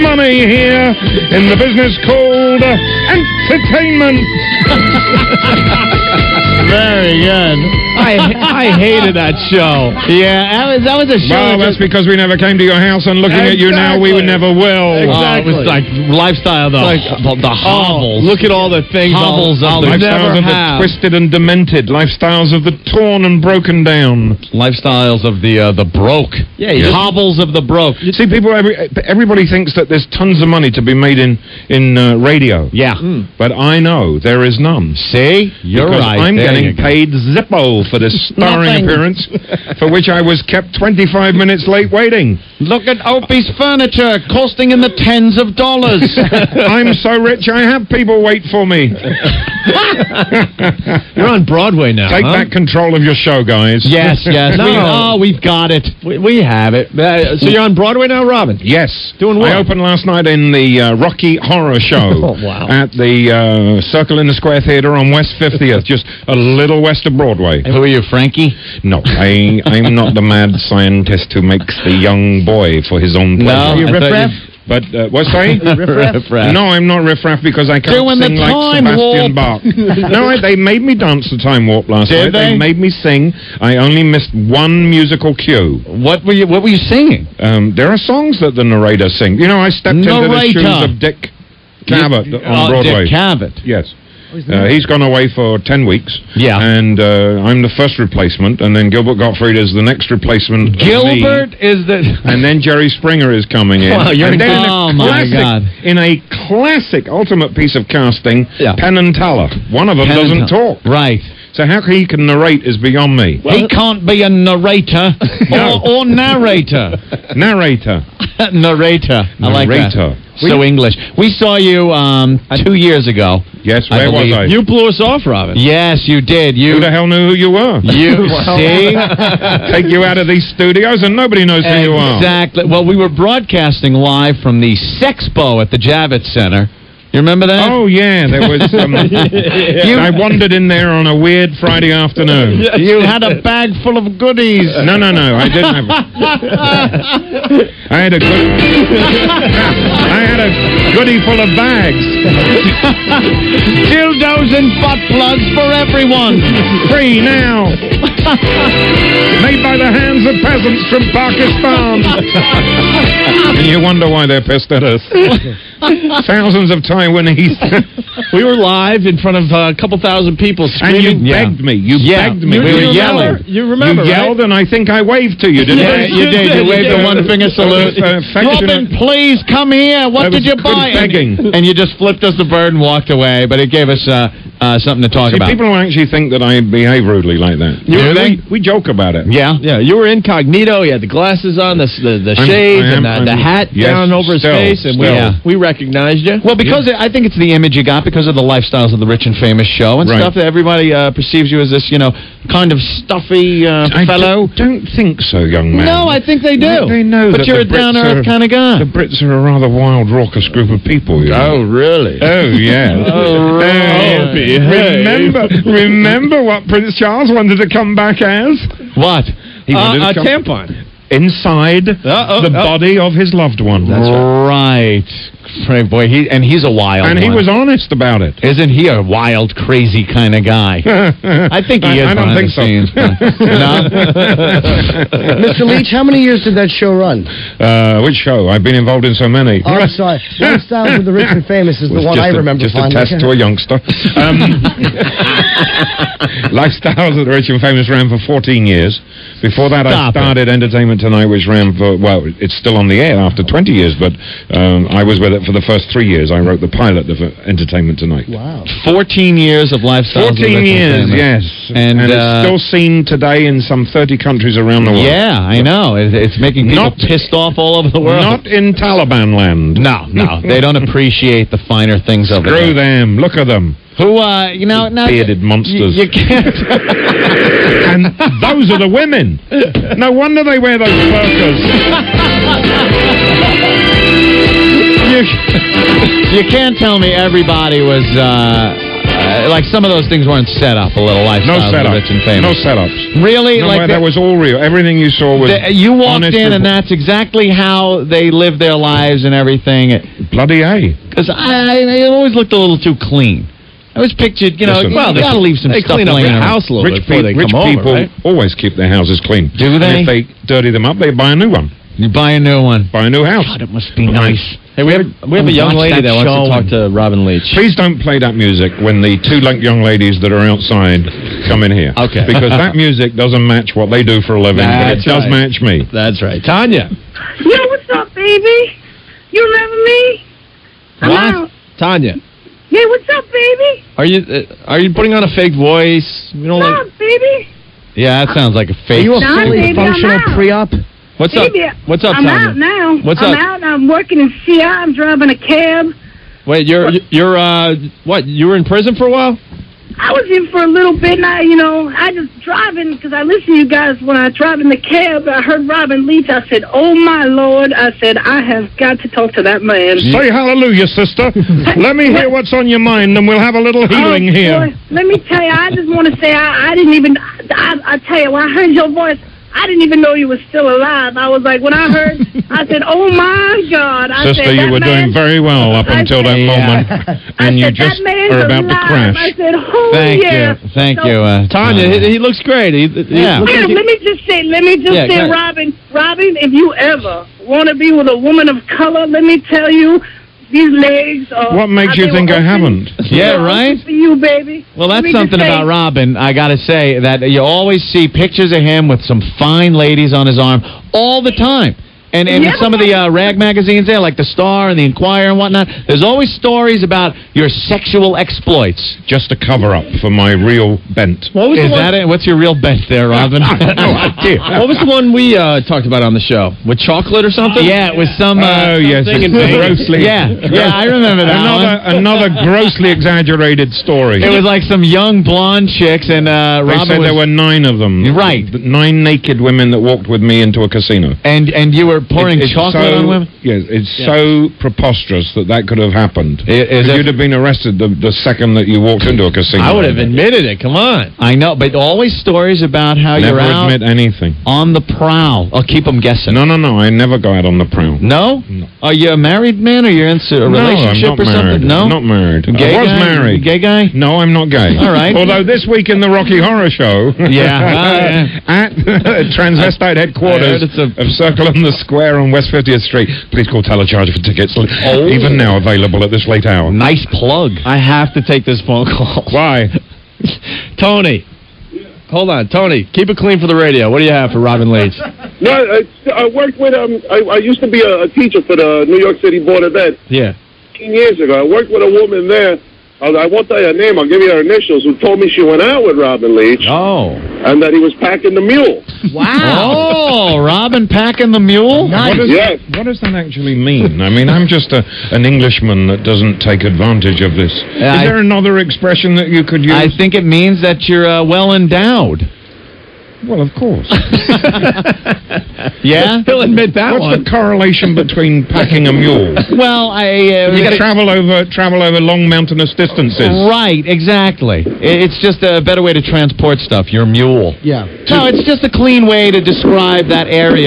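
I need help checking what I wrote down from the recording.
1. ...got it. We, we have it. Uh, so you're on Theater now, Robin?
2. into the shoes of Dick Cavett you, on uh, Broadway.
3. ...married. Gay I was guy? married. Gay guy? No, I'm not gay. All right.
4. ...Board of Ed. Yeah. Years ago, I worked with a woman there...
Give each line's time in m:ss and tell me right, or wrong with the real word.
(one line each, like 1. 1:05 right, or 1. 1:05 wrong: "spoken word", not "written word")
1. 0:55 wrong: "Broadway", not "Theater"
2. 1:30 right
3. 7:32 right
4. 7:59 right.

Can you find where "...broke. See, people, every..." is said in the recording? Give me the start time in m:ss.
0:27.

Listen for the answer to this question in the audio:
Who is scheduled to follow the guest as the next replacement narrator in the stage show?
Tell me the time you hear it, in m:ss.
1:38.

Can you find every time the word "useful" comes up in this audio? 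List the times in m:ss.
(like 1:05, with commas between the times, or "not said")
not said.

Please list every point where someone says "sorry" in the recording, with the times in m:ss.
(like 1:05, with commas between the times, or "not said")
1:15, 3:59.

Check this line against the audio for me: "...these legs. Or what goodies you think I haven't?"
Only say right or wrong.
wrong.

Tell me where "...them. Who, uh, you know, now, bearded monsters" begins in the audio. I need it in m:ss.
4:33.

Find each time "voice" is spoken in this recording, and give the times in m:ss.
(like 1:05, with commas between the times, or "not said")
5:35, 6:08.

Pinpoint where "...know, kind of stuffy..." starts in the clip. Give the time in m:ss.
3:22.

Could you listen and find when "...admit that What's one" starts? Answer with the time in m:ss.
8:26.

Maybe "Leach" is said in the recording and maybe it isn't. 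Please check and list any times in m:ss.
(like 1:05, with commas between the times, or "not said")
3:55, 5:17, 5:56, 7:54, 8:06.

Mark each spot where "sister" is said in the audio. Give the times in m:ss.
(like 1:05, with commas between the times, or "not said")
6:00, 6:14.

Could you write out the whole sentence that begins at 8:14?
I mean, I'm just a, an Englishman that doesn't take advantage of this.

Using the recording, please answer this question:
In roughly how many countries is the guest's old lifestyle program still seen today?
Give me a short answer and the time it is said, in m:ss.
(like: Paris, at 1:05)
30, at 4:23.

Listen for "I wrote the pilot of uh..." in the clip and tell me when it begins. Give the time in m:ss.
4:16.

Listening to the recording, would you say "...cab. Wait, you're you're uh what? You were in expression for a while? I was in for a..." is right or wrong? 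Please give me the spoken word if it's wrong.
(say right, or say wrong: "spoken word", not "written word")
wrong: "prison", not "expression".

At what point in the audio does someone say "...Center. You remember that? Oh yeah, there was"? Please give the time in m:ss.
2:16.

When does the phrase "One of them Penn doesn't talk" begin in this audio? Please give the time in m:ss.
1:49.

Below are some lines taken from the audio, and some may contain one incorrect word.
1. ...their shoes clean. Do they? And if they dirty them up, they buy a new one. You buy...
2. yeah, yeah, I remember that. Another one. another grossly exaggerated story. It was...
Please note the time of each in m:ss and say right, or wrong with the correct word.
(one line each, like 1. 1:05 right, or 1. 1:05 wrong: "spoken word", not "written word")
1. 5:08 wrong: "houses", not "shoes"
2. 7:00 right.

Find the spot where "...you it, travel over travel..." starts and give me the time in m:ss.
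8:30.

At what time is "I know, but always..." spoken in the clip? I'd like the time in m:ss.
7:21.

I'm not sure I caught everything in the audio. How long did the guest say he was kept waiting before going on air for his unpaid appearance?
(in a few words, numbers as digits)
25 minutes.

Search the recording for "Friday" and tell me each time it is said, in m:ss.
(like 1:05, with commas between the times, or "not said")
2:21.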